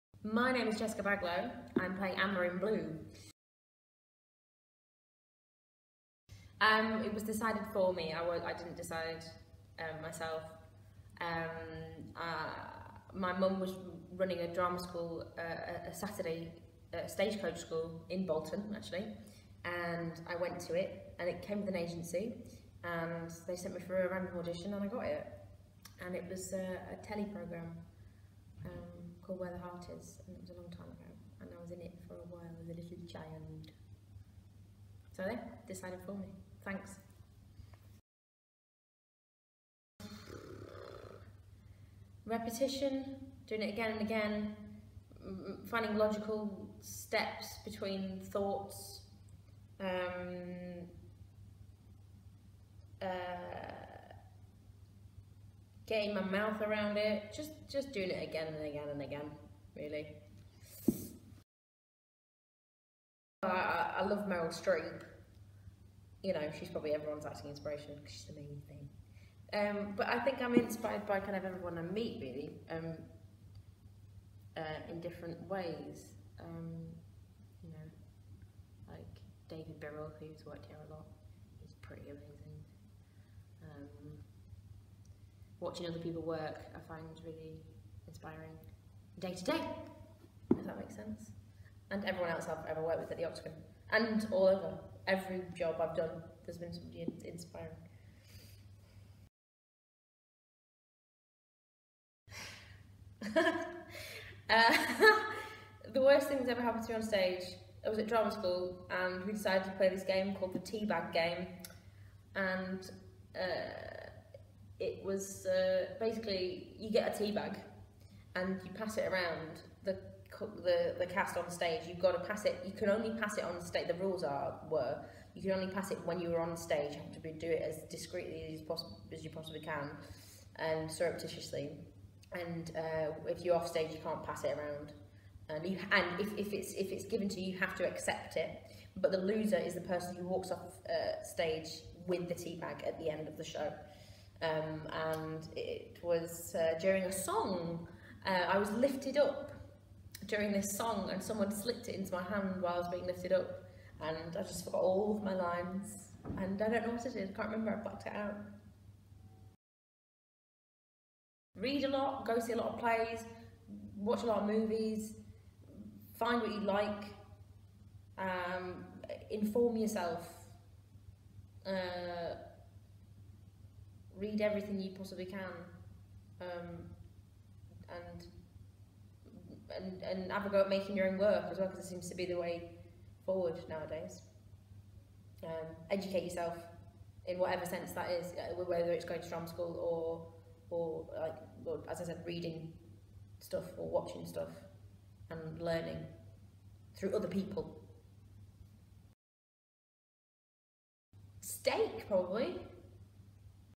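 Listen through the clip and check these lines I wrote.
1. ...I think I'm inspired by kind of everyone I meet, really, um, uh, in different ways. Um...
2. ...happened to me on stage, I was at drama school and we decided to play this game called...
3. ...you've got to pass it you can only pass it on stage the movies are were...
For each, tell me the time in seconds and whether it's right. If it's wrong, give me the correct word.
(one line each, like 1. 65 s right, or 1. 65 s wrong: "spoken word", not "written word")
1. 70 s right
2. 106 s right
3. 121 s wrong: "rules", not "movies".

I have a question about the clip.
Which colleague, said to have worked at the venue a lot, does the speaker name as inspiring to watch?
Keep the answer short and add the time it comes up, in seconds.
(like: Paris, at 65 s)
David Birrell, at 79 s.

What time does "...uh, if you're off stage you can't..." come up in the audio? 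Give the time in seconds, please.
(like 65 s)
132 s.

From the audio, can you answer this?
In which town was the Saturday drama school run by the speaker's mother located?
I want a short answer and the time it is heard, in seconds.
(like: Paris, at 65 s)
Bolton, at 18 s.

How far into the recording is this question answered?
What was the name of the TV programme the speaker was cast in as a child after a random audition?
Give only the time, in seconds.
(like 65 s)
29 s.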